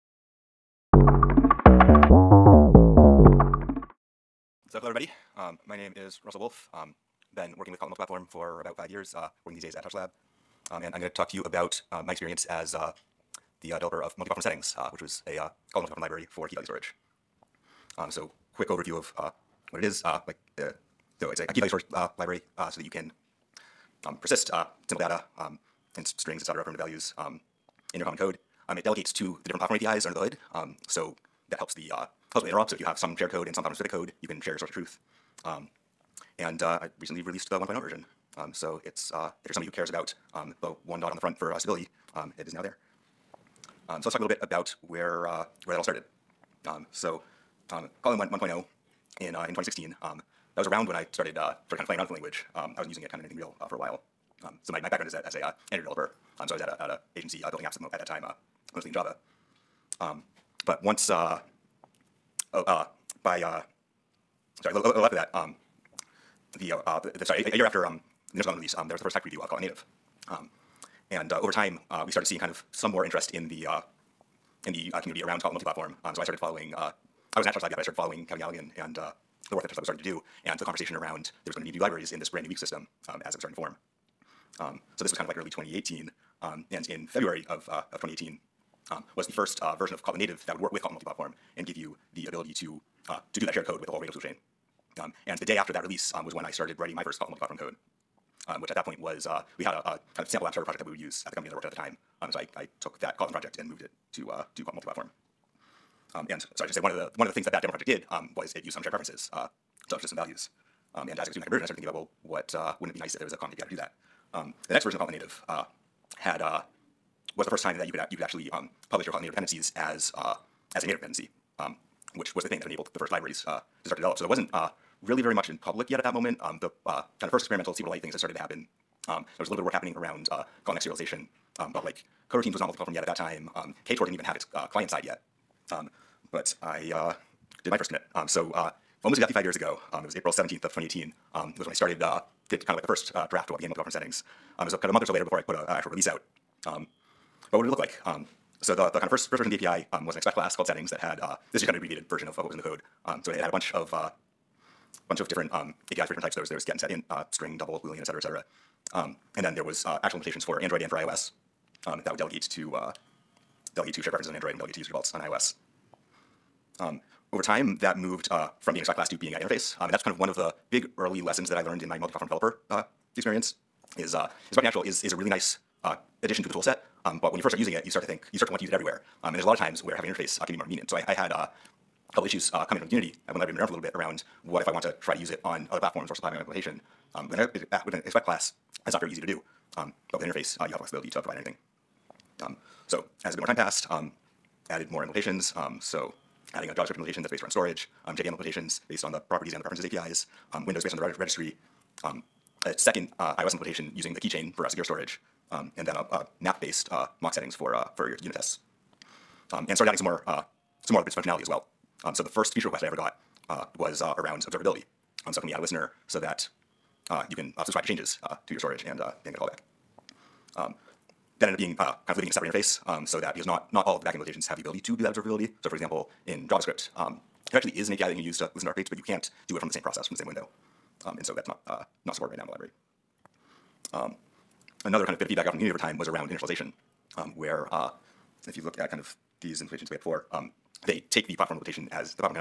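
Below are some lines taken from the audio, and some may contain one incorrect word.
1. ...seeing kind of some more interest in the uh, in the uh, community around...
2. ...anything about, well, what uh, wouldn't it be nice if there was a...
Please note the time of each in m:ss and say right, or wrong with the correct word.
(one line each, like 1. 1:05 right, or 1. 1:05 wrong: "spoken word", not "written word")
1. 1:12 right
2. 1:51 wrong: "thinking", not "anything".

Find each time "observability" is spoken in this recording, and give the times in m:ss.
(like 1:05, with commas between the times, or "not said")
3:34, 3:45.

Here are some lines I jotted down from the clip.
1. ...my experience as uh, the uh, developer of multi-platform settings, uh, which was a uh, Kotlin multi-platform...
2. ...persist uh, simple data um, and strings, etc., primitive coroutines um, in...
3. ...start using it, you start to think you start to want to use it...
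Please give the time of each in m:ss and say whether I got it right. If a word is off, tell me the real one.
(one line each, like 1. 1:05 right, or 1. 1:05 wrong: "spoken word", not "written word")
1. 0:12 right
2. 0:24 wrong: "values", not "coroutines"
3. 2:57 right.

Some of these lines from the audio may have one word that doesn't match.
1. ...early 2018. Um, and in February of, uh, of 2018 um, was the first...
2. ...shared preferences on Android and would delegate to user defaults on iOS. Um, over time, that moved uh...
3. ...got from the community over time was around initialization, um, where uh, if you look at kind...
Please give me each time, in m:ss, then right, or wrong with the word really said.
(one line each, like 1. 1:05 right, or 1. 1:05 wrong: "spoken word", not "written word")
1. 1:25 right
2. 2:44 right
3. 3:55 right.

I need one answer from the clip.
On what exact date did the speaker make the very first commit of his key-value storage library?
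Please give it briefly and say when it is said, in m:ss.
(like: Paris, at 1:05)
April 17, 2018, at 2:20.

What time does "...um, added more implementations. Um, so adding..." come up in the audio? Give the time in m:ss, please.
3:13.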